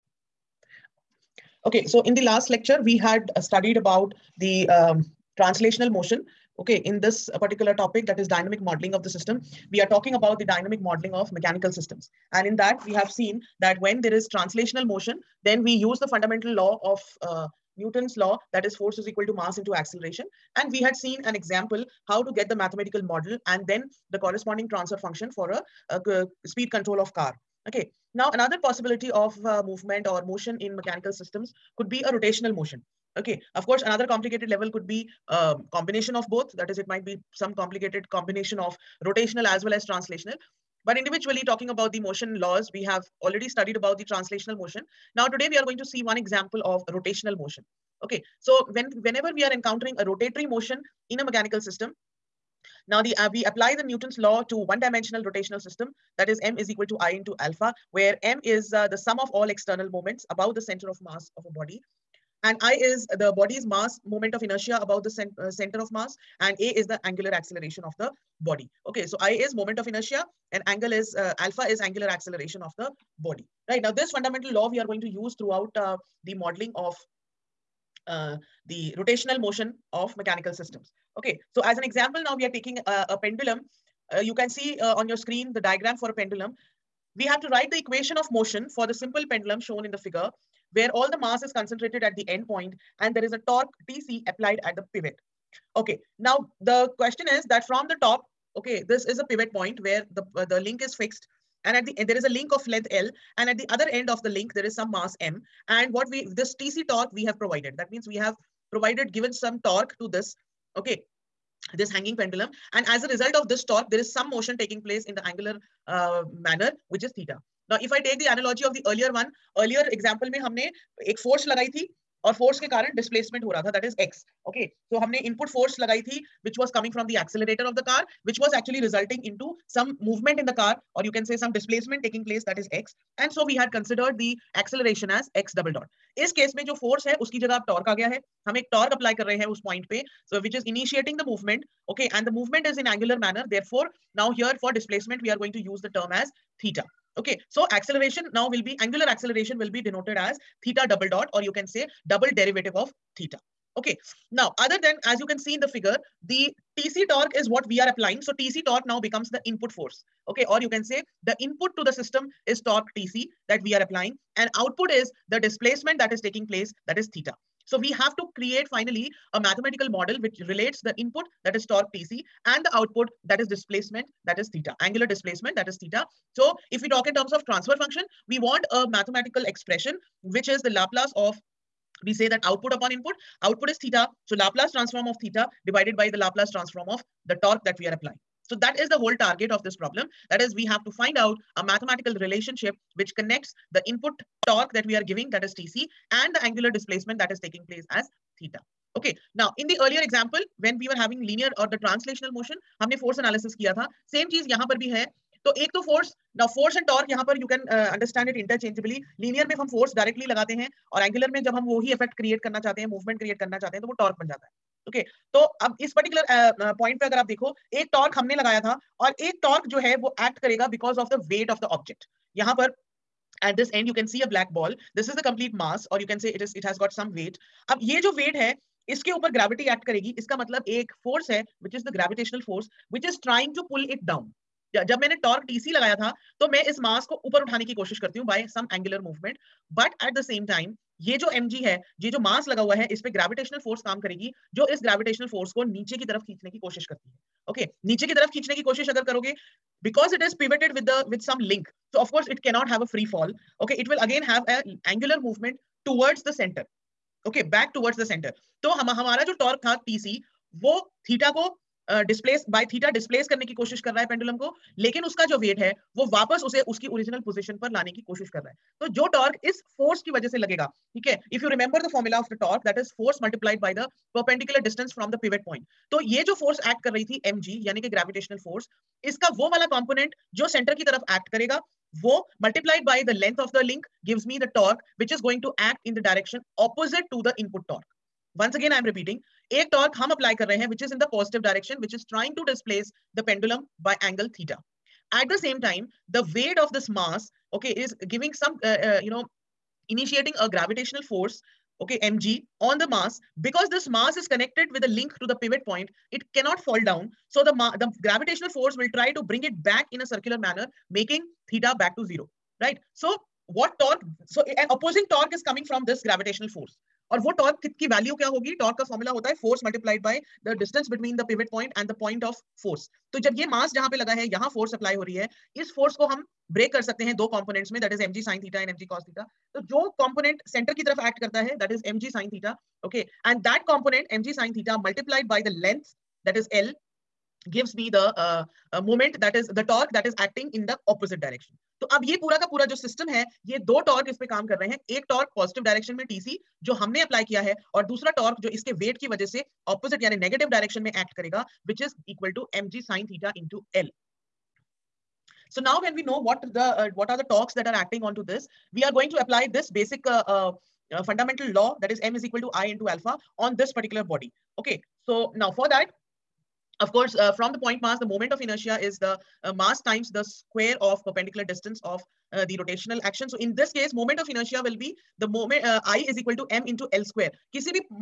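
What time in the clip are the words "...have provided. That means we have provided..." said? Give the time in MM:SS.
01:47.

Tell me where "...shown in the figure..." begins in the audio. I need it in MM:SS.
01:29.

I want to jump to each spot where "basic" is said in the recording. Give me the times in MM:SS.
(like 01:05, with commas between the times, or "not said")
05:59.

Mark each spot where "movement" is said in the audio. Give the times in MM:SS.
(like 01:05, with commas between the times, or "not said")
00:29, 02:10, 03:32, 04:15.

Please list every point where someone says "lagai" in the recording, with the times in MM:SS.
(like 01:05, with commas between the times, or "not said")
02:01, 02:05.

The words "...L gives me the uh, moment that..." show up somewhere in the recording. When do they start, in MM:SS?
05:36.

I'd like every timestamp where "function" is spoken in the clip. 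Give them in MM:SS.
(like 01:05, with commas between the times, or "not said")
00:25, 02:57.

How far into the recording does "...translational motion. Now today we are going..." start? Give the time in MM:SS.
00:44.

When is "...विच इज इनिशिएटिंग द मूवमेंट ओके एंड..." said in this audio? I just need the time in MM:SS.
02:20.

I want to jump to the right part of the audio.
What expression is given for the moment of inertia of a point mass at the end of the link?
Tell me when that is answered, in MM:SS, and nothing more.
06:16.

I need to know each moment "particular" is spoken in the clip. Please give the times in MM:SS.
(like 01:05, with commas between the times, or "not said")
00:07, 06:03.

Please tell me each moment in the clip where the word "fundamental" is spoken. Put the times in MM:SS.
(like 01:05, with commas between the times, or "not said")
00:16, 01:14, 06:01.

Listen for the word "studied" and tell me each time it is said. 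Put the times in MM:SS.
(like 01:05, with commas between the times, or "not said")
00:03, 00:43.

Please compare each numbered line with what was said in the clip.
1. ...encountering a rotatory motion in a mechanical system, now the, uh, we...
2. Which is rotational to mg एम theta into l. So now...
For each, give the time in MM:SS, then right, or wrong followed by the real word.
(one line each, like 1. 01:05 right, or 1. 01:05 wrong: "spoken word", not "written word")
1. 00:49 right
2. 05:51 wrong: "equal", not "rotational".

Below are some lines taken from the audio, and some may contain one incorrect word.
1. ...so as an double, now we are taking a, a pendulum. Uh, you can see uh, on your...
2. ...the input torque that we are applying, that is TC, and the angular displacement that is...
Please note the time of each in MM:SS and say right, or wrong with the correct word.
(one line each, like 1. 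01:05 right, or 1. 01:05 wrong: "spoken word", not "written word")
1. 01:21 wrong: "example", not "double"
2. 03:13 wrong: "giving", not "applying".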